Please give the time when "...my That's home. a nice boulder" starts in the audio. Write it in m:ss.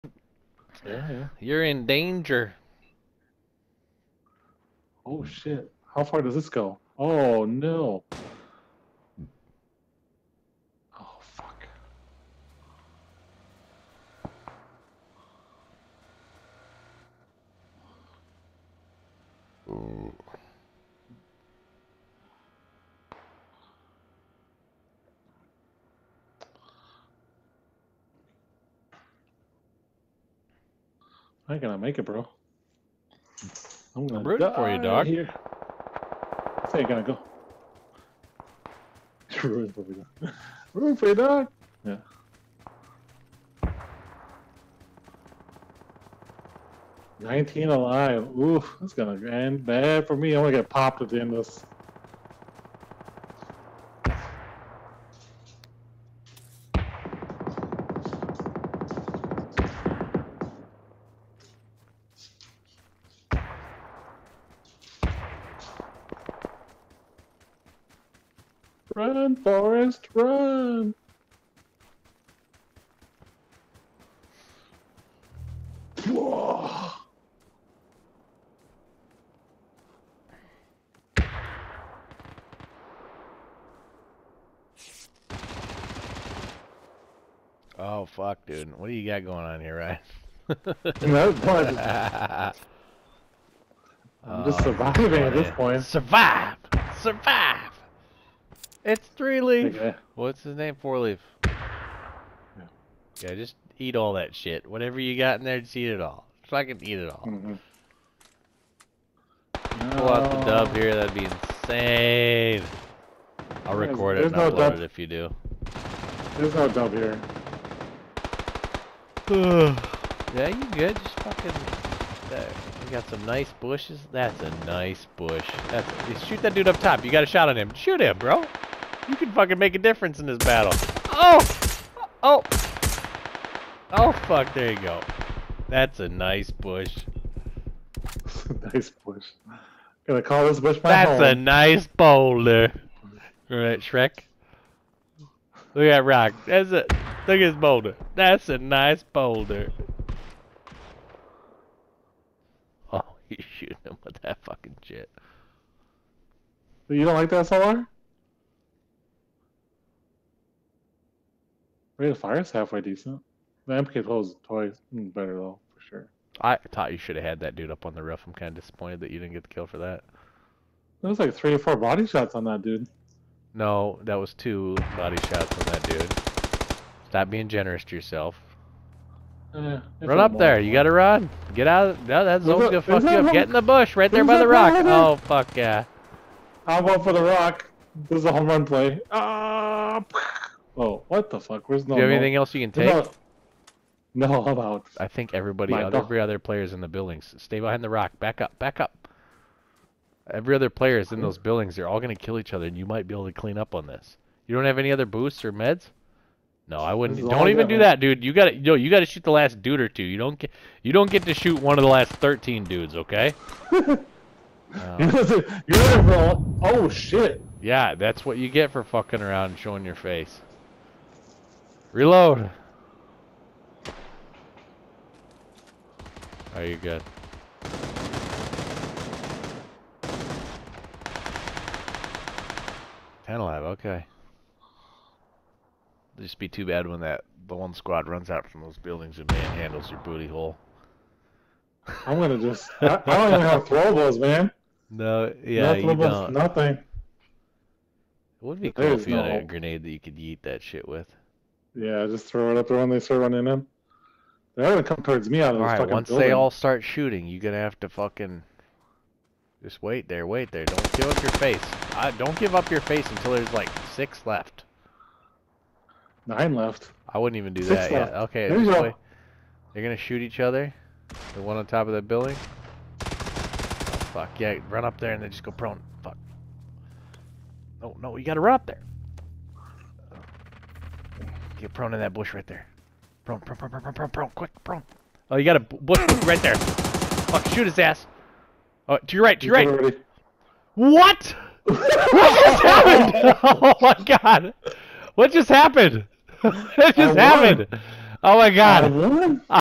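2:20.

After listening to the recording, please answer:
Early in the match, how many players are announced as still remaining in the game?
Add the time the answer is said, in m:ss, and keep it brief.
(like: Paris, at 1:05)
19, at 0:47.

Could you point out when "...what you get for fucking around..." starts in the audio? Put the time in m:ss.
3:38.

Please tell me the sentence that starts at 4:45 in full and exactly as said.
Oh, you got a bush right there.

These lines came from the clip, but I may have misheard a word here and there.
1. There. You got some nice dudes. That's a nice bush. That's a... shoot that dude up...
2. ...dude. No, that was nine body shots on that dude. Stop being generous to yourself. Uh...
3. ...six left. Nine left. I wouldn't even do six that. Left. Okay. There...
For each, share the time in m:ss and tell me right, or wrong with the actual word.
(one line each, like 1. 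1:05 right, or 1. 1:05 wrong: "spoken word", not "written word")
1. 2:02 wrong: "bushes", not "dudes"
2. 2:52 wrong: "two", not "nine"
3. 4:23 right.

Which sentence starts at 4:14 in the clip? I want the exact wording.
They're gonna come towards me out of all this right, fucking once building.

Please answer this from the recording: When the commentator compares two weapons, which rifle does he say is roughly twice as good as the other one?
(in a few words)
MK12.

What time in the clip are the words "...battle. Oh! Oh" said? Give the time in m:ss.
2:10.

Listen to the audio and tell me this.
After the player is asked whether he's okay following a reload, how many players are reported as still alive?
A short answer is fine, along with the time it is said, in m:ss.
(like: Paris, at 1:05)
10, at 3:53.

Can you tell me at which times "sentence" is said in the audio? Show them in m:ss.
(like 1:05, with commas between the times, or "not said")
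not said.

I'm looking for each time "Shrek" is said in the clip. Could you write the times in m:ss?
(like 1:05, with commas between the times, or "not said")
2:23.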